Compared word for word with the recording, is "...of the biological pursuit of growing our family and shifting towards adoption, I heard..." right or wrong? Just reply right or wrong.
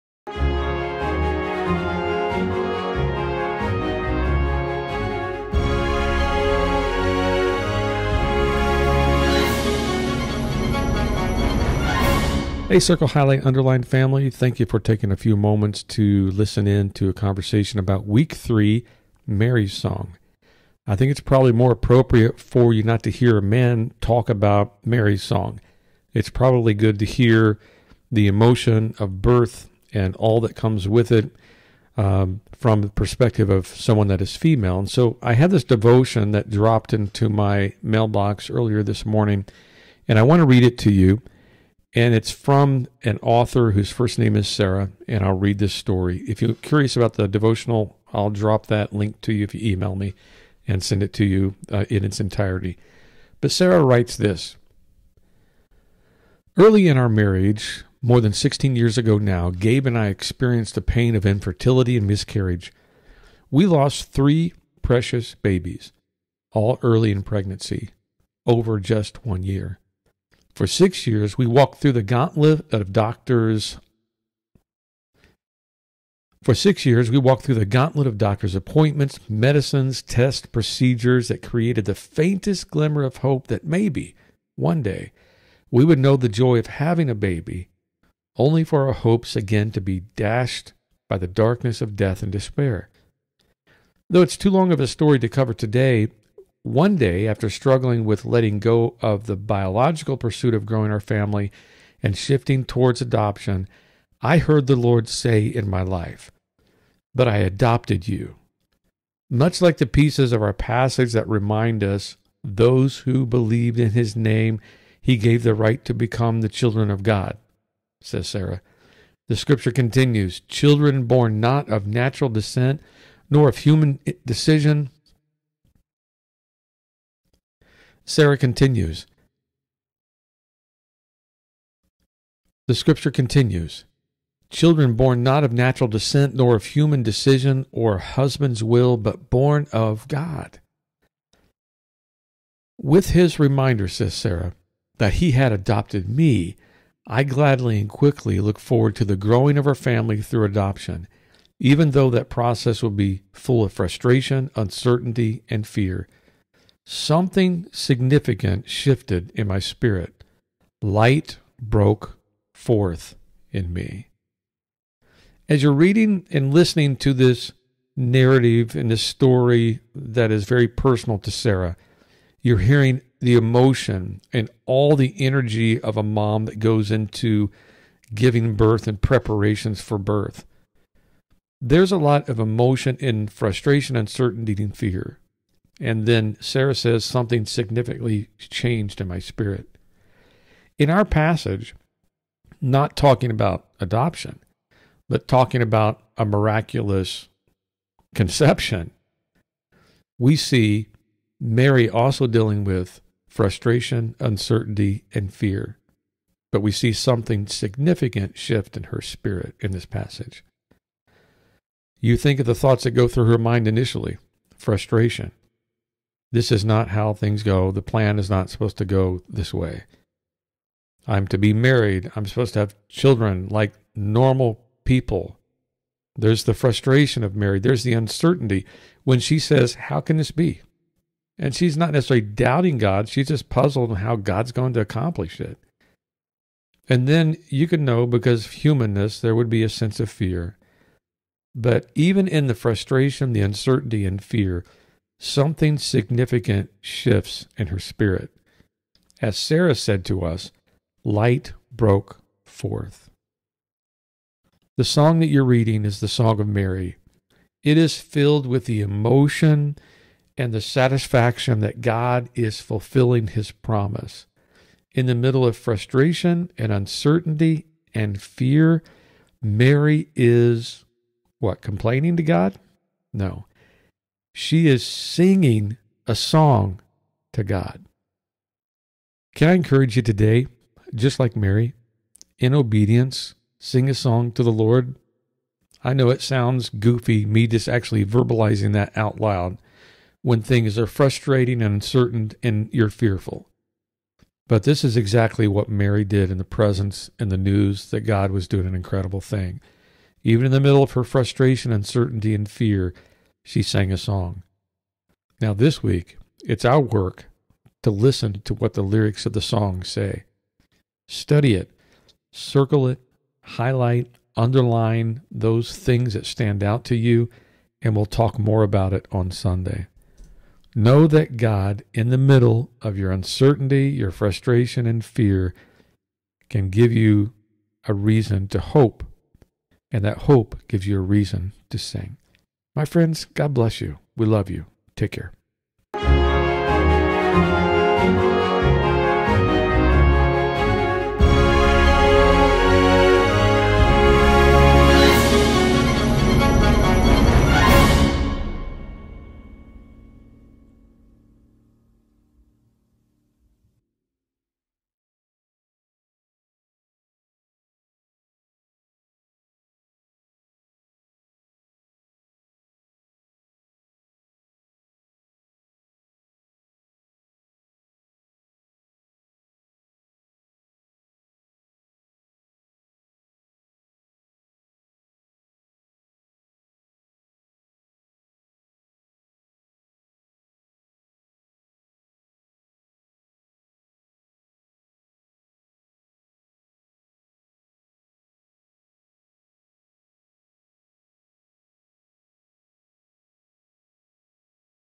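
right.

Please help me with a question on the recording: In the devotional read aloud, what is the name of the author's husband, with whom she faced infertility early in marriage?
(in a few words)
Gabe.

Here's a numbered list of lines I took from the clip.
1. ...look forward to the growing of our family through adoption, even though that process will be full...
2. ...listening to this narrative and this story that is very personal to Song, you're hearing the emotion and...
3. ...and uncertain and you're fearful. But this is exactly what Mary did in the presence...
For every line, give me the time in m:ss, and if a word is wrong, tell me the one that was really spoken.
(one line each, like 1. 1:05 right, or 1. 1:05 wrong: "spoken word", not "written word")
1. 2:28 right
2. 2:46 wrong: "Sarah", not "Song"
3. 4:51 right.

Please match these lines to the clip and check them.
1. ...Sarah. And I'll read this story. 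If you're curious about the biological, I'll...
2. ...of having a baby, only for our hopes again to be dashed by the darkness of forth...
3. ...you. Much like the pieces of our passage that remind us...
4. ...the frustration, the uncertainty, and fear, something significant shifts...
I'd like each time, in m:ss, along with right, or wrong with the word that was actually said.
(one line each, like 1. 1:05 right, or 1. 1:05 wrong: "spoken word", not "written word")
1. 0:44 wrong: "devotional", not "biological"
2. 1:26 wrong: "death", not "forth"
3. 1:48 right
4. 4:02 right.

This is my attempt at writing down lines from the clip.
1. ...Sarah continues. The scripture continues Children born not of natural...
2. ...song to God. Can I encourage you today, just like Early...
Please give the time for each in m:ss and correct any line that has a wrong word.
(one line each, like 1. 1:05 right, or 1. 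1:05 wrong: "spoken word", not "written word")
1. 2:08 right
2. 4:36 wrong: "Mary", not "Early".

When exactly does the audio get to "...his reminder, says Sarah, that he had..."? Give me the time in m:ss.
2:23.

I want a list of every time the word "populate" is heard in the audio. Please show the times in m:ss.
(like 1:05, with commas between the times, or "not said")
not said.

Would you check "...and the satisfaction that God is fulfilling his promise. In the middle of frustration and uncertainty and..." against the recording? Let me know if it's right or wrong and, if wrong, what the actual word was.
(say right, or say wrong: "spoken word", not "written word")
right.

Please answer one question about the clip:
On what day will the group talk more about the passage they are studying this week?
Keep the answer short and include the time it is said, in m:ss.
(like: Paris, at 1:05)
Sunday, at 5:19.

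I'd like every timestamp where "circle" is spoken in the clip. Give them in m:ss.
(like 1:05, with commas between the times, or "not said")
0:12, 5:12.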